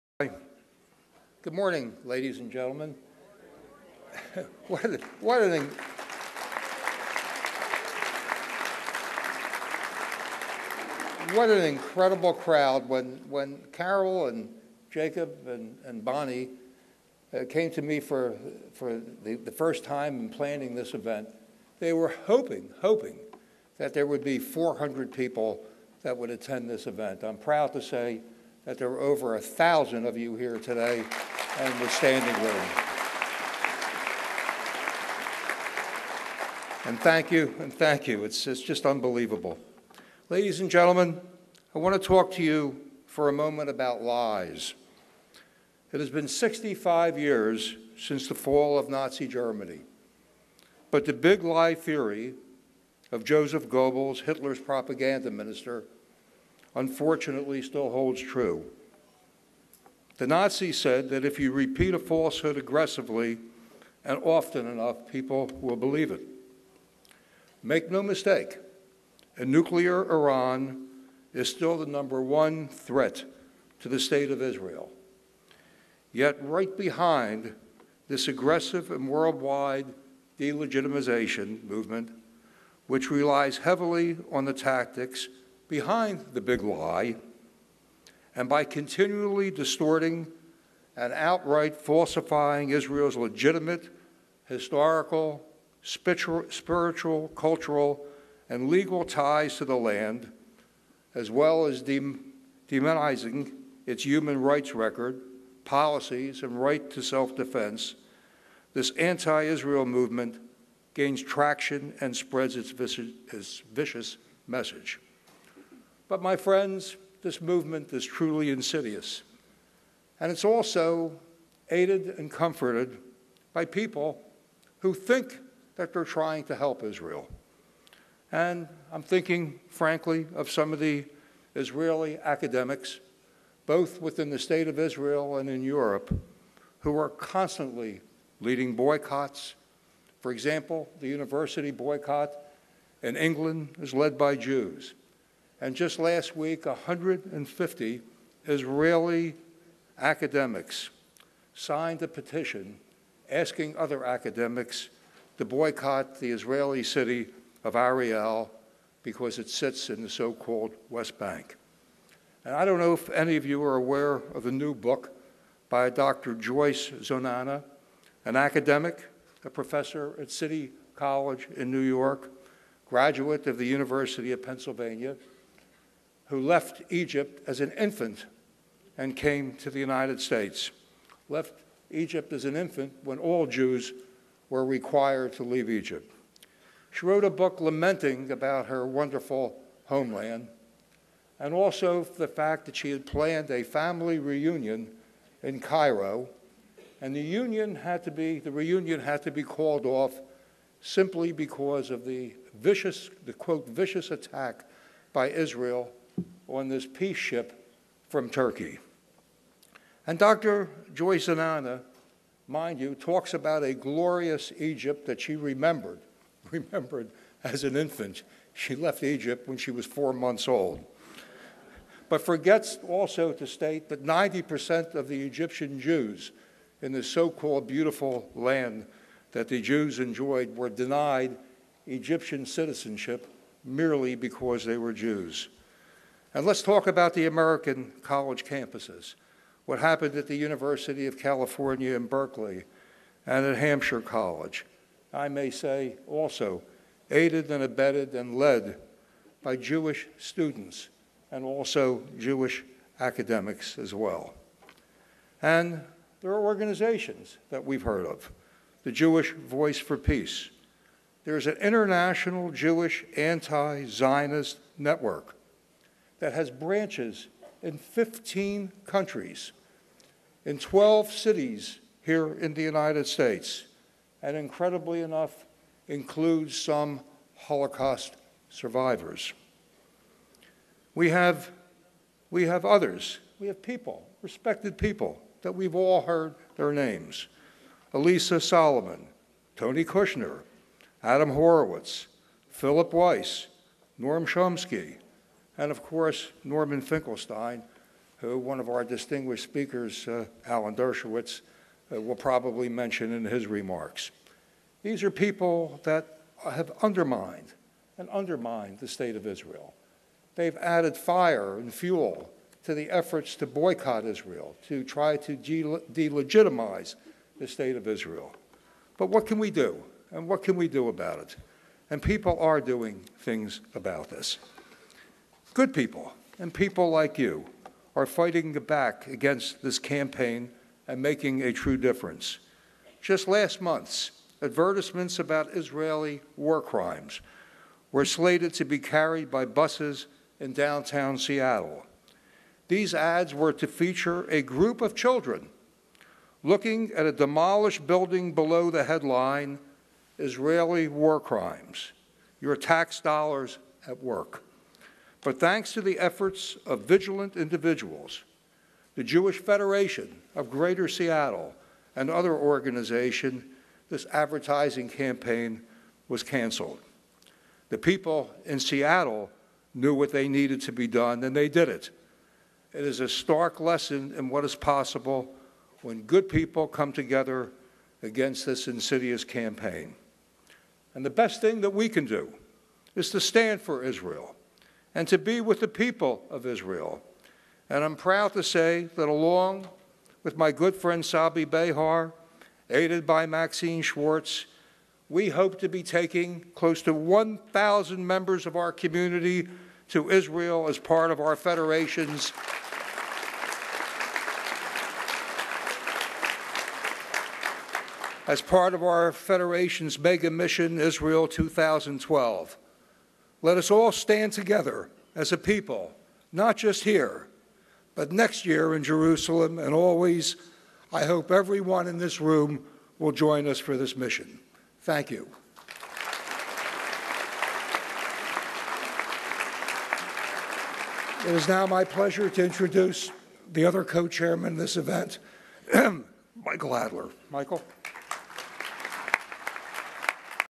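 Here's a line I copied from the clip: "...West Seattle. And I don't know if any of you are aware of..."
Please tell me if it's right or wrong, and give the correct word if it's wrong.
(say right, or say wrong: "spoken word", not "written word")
wrong: "Bank", not "Seattle".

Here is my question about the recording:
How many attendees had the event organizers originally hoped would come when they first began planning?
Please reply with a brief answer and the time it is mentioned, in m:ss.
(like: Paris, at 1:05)
400, at 0:24.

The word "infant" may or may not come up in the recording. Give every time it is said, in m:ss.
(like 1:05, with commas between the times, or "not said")
2:57, 3:02, 3:37.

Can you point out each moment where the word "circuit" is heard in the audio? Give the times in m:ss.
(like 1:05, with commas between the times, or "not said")
not said.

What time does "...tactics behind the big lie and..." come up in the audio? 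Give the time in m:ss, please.
1:24.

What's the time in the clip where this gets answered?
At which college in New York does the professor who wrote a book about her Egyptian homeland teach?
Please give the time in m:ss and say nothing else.
2:50.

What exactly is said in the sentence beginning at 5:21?
And people are doing things about this.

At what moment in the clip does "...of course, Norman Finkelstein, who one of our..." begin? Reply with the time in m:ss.
4:55.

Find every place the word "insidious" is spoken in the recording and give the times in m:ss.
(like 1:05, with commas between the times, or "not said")
1:58, 6:18.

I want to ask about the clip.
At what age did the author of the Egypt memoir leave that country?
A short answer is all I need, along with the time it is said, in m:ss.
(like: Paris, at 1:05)
4 months, at 3:39.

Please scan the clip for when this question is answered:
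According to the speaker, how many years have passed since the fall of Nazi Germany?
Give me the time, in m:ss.
0:46.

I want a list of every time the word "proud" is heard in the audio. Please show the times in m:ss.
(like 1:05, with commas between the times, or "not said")
0:27, 6:27.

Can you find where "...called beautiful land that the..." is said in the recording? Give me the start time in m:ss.
3:47.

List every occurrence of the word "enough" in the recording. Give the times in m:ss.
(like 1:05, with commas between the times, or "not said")
1:04, 4:35.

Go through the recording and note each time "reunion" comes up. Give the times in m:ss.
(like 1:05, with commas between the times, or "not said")
3:14, 3:18.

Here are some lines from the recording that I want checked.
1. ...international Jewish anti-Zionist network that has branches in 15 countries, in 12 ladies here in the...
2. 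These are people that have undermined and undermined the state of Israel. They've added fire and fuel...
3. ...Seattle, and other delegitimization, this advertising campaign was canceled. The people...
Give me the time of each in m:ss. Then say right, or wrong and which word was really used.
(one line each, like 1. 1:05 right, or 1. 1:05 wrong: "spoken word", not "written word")
1. 4:21 wrong: "cities", not "ladies"
2. 5:04 right
3. 6:00 wrong: "organization", not "delegitimization".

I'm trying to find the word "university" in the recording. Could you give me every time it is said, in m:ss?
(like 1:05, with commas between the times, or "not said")
2:21, 2:53, 4:00.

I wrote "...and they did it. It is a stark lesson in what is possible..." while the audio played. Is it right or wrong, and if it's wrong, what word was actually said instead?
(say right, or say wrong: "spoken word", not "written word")
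right.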